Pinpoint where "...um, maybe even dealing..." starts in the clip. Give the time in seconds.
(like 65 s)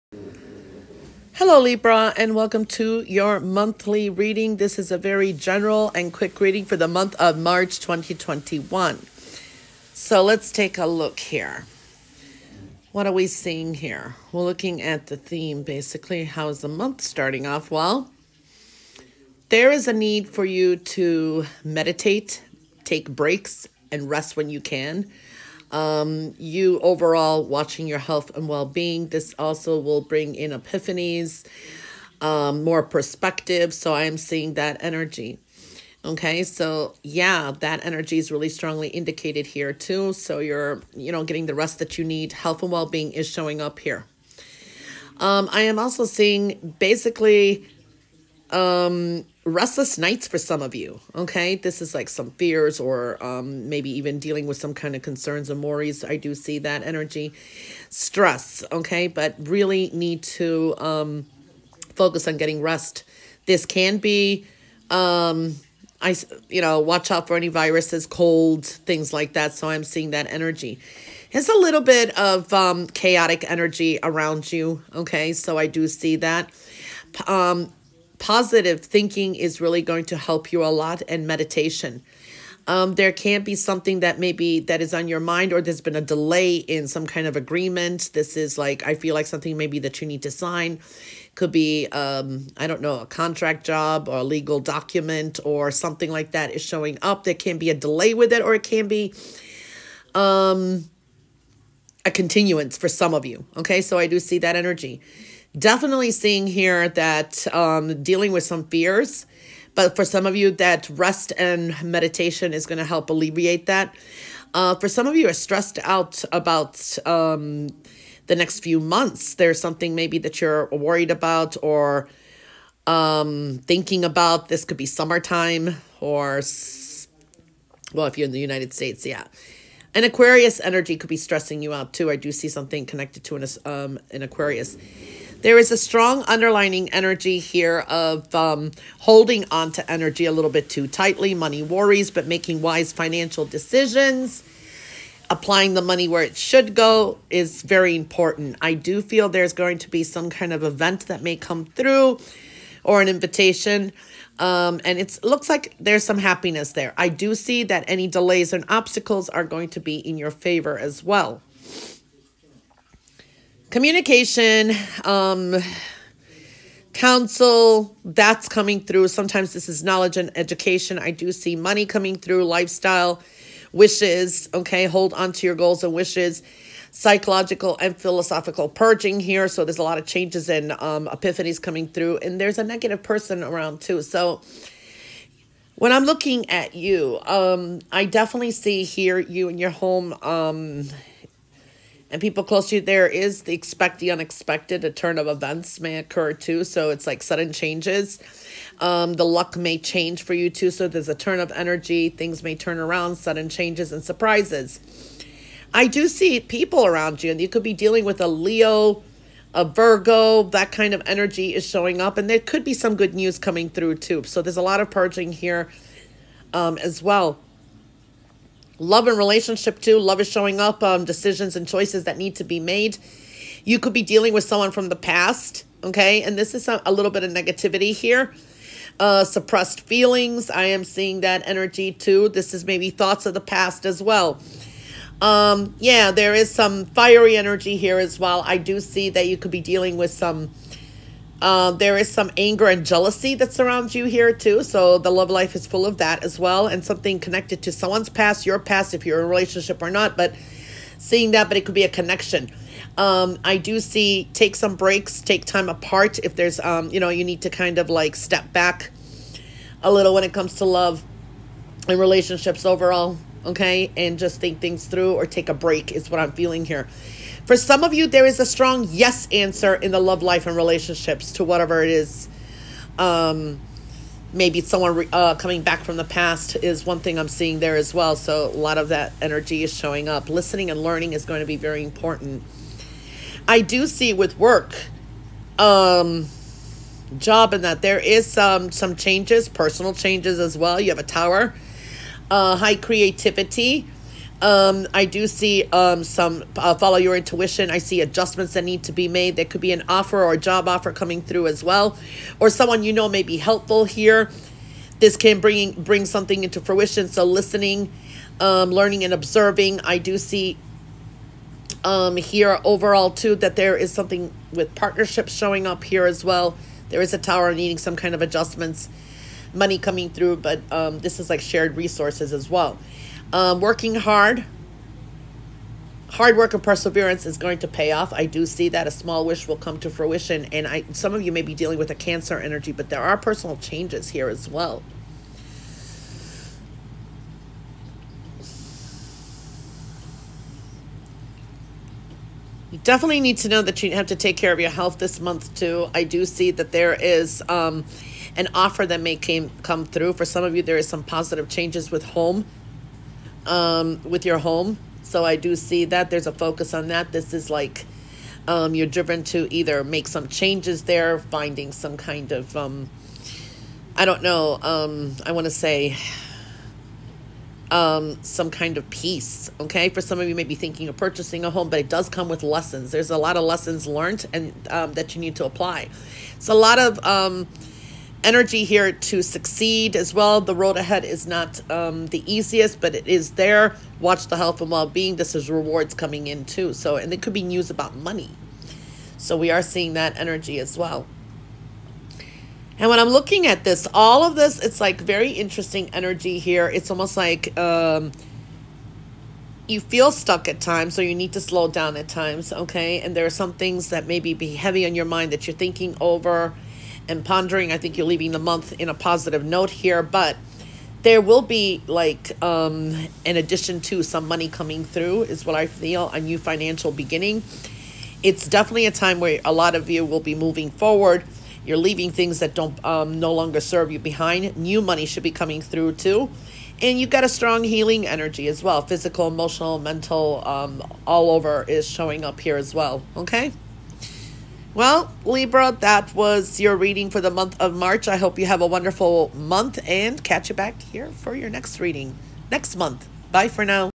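53 s.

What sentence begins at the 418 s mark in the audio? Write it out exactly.
It's definitely a time where a lot of you will be moving forward.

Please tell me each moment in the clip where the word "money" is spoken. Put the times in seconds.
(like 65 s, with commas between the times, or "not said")
141 s, 145 s, 171 s, 319 s, 387 s, 414 s, 424 s.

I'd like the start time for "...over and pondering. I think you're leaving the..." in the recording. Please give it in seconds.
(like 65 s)
406 s.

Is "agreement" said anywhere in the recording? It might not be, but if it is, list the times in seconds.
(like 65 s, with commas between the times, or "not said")
87 s.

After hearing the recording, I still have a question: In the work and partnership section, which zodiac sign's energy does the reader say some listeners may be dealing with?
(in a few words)
Cancer.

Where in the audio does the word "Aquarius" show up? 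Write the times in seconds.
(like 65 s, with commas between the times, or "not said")
130 s, 134 s.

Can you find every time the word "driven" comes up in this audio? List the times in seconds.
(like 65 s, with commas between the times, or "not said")
358 s.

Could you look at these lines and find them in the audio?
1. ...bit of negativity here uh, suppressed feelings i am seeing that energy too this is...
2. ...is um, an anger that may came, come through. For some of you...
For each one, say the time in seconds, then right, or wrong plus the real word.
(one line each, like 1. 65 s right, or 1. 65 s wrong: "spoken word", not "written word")
1. 227 s right
2. 346 s wrong: "offer", not "anger".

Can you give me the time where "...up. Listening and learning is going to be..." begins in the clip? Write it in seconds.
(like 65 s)
280 s.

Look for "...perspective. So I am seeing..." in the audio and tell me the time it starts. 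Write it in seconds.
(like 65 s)
32 s.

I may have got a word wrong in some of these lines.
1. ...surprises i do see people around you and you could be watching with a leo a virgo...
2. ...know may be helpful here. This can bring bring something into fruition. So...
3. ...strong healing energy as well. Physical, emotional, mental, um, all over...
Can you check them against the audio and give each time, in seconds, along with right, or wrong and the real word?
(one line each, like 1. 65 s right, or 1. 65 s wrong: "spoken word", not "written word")
1. 204 s wrong: "dealing", not "watching"
2. 302 s right
3. 427 s right.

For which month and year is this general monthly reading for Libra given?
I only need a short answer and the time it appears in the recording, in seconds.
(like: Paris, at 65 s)
March 2021, at 7 s.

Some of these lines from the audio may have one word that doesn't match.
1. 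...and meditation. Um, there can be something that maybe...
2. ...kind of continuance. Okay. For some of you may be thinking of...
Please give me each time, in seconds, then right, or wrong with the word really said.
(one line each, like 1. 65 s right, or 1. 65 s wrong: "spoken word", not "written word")
1. 81 s right
2. 368 s wrong: "peace", not "continuance".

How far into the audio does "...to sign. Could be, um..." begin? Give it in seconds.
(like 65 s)
90 s.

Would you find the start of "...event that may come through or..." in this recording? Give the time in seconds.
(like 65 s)
150 s.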